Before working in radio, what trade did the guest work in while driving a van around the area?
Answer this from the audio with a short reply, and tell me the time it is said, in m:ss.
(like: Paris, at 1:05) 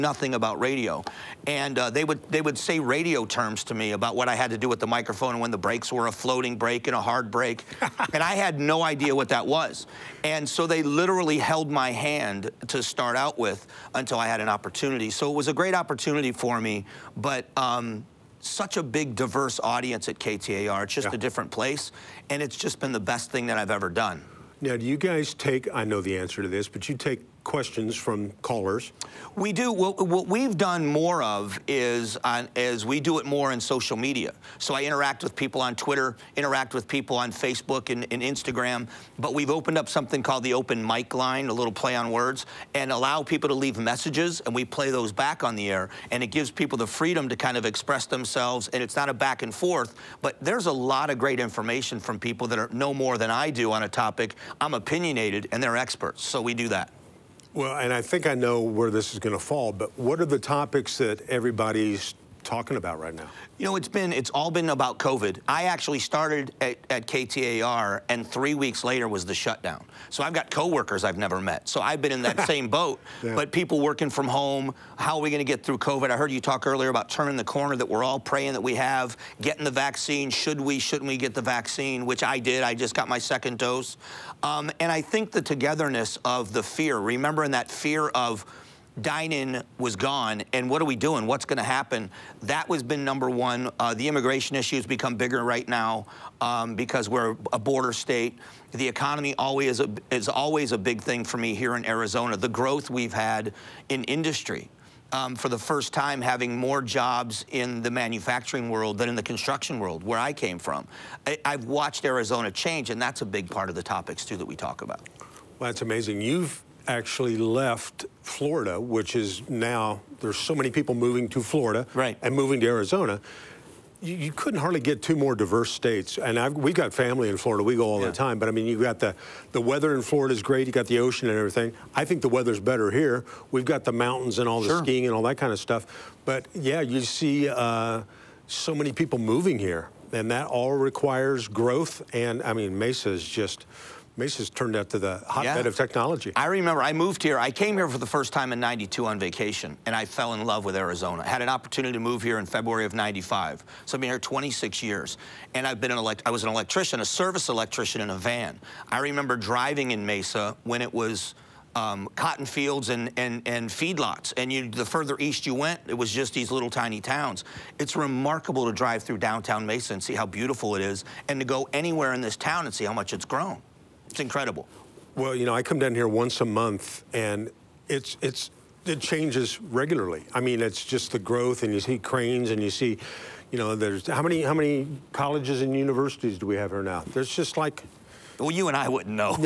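service electrician, at 2:37.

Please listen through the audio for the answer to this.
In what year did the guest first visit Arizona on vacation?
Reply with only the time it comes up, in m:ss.
2:28.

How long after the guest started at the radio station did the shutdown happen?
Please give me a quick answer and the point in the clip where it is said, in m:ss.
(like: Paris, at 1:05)
3 weeks, at 1:08.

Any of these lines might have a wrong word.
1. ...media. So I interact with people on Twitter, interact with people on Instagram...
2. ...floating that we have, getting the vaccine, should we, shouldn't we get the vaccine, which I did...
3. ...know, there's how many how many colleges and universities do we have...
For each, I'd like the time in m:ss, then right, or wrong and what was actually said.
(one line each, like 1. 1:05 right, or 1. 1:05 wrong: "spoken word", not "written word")
1. 0:33 wrong: "Facebook", not "Instagram"
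2. 1:18 wrong: "praying", not "floating"
3. 3:03 right.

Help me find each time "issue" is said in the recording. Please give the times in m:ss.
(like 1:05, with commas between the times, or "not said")
1:34.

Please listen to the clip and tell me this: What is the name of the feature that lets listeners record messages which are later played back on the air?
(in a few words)
open mic line.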